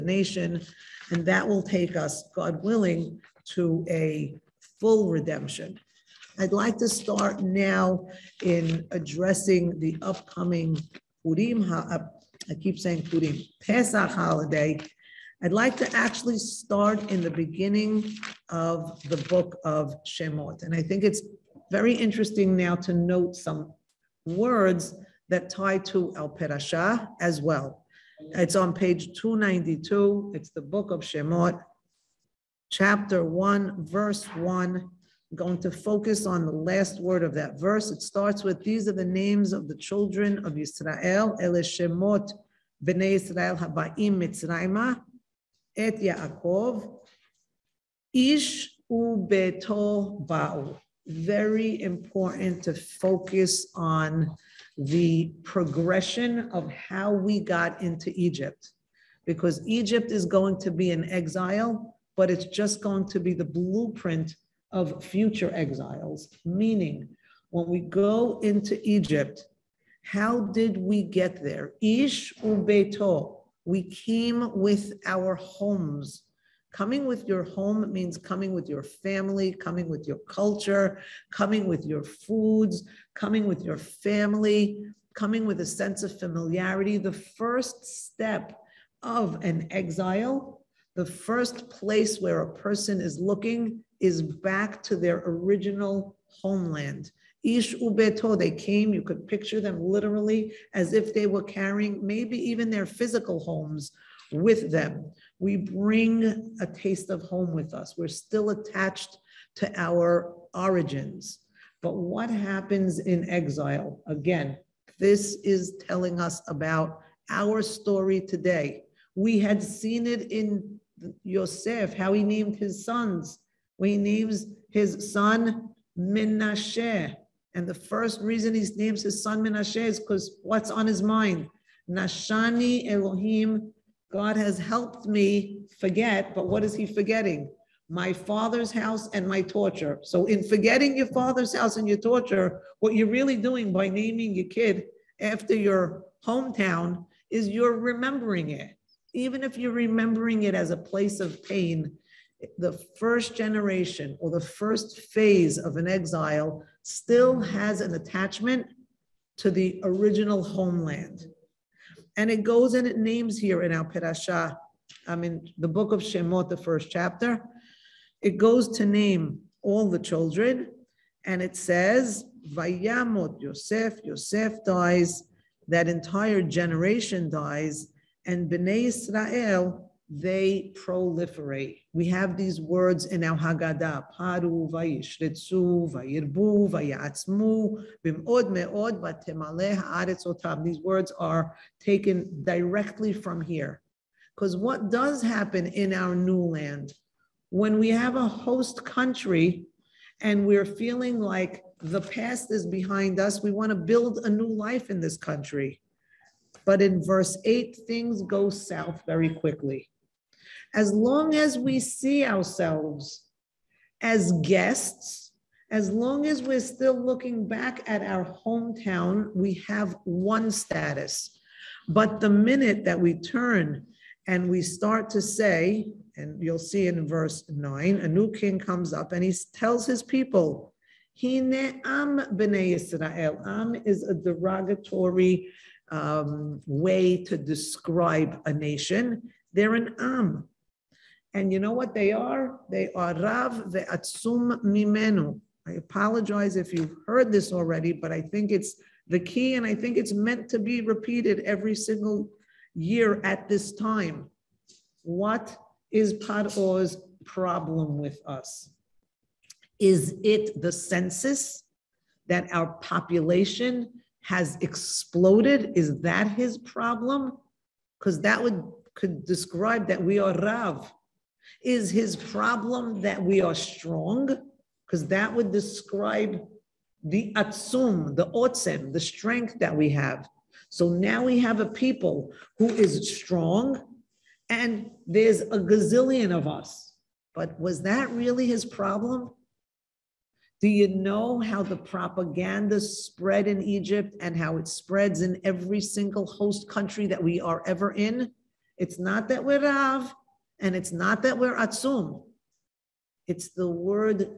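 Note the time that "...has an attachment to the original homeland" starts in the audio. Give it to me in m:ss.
2:37.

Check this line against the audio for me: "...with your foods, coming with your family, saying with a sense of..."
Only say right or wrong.
wrong.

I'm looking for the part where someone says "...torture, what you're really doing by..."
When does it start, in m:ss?
2:21.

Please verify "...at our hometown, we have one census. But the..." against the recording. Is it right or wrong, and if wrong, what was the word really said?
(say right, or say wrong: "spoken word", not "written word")
wrong: "status", not "census".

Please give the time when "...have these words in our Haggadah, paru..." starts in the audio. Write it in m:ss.
3:02.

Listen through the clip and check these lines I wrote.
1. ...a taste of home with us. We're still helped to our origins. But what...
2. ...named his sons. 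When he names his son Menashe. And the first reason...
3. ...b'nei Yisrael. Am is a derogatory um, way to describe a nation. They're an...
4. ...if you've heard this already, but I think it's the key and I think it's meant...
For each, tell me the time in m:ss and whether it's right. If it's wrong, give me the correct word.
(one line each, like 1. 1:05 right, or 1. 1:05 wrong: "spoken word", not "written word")
1. 1:46 wrong: "attached", not "helped"
2. 2:02 right
3. 3:52 right
4. 4:06 right.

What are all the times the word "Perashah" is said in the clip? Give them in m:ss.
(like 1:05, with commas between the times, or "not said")
0:26, 2:43.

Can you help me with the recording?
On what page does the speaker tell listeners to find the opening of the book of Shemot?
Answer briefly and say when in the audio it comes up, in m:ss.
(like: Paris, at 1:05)
292, at 0:29.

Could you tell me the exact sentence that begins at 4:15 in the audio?
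What is Par'o's problem with us?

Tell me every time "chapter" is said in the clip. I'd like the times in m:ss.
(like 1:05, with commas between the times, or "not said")
0:32, 2:46.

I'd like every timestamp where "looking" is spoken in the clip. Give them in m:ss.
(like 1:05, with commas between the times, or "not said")
1:33, 3:36.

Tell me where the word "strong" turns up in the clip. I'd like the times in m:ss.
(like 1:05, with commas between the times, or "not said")
4:33, 4:43.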